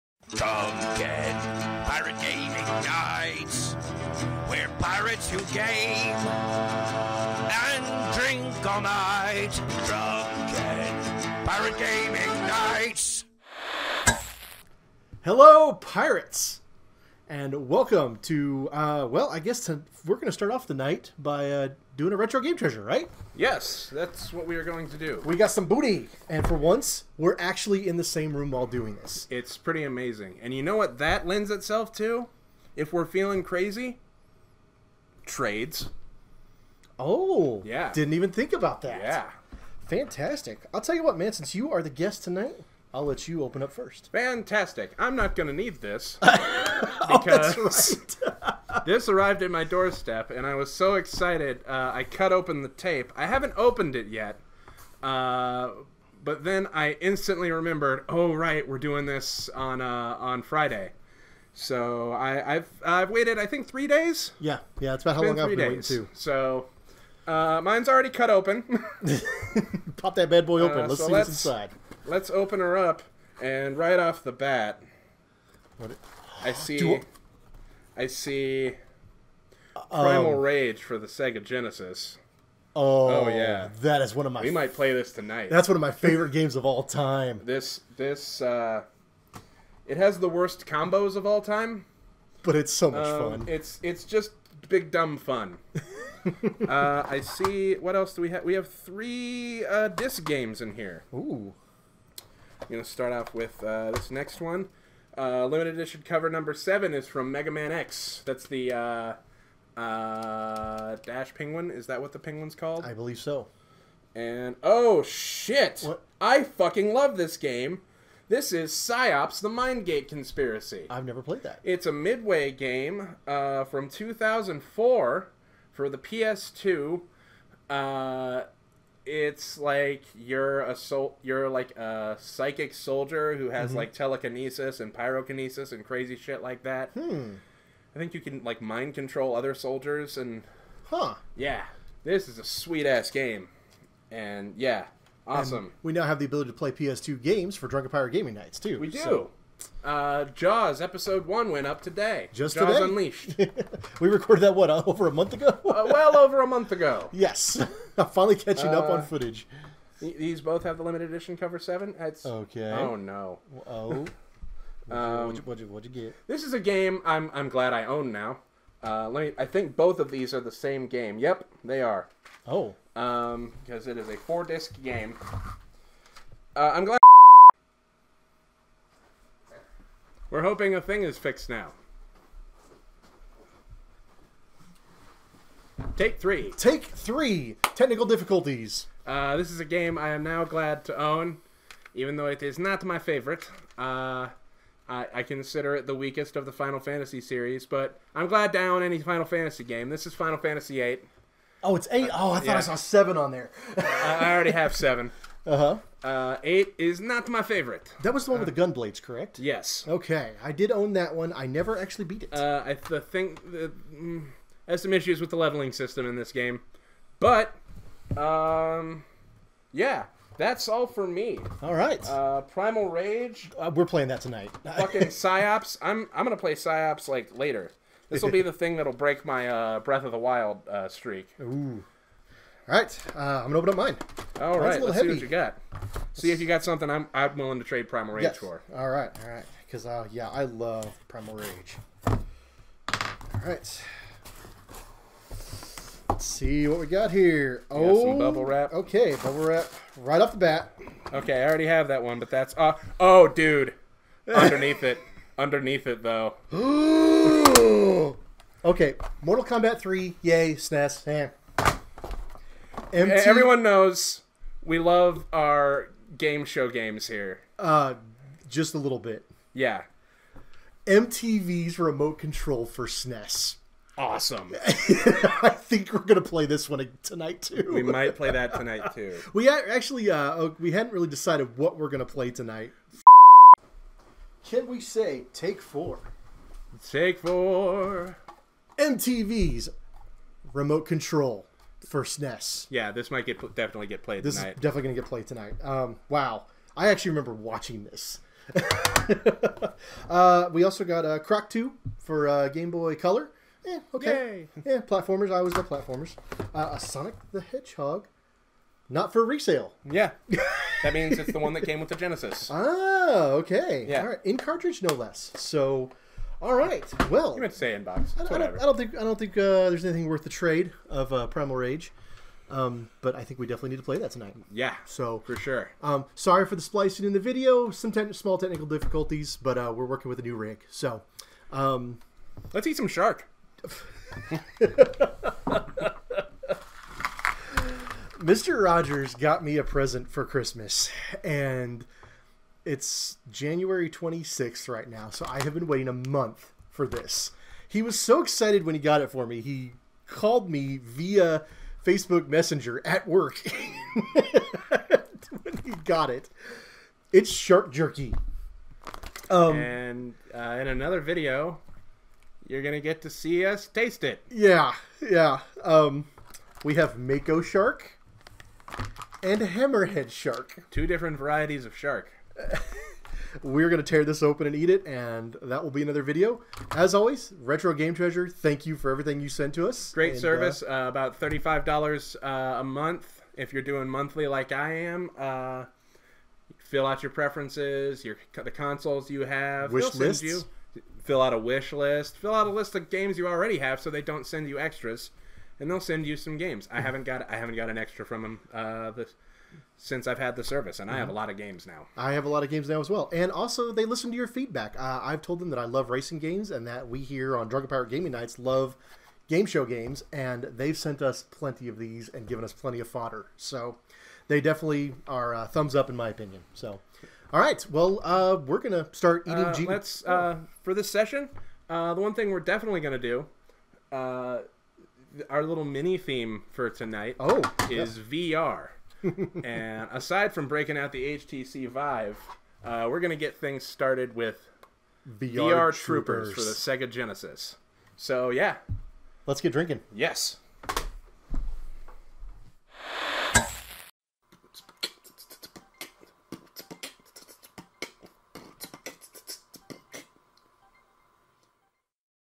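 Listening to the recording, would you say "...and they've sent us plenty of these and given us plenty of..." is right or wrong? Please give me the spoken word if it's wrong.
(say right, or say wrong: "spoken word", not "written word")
right.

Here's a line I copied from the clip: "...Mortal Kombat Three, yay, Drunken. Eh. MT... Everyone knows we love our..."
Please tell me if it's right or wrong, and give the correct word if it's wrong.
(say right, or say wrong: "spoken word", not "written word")
wrong: "SNES", not "Drunken".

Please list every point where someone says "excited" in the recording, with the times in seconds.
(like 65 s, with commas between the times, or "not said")
50 s, 348 s.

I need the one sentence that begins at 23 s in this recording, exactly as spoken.
Yes, that's what we are going to do.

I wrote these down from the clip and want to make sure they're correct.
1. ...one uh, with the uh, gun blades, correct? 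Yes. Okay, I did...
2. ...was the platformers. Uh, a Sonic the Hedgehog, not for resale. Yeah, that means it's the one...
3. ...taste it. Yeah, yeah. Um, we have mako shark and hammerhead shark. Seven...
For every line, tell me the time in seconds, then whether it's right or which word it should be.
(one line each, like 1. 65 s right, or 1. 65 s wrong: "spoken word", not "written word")
1. 208 s right
2. 305 s right
3. 363 s wrong: "Two", not "Seven".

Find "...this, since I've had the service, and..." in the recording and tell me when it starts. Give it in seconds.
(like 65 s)
398 s.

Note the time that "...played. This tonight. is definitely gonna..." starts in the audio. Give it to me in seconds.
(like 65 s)
294 s.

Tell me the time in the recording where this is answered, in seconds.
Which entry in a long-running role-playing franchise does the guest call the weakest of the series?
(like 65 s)
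200 s.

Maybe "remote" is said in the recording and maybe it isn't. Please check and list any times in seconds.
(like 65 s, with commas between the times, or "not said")
271 s, 290 s.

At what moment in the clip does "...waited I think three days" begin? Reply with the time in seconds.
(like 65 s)
63 s.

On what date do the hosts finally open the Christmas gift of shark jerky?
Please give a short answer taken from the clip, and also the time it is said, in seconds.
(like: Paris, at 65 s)
January 26th, at 343 s.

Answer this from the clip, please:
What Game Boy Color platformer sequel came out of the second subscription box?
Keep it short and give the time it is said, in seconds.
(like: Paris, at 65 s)
Croc 2, at 301 s.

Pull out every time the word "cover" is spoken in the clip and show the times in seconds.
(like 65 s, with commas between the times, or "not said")
106 s, 161 s.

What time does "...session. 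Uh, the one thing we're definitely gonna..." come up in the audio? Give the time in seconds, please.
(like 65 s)
420 s.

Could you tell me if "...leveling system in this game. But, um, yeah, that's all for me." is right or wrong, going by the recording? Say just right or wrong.
right.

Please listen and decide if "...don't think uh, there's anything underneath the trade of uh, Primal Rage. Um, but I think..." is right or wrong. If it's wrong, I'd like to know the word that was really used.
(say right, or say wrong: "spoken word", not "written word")
wrong: "worth", not "underneath".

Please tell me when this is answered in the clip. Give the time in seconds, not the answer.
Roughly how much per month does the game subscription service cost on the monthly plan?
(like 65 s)
381 s.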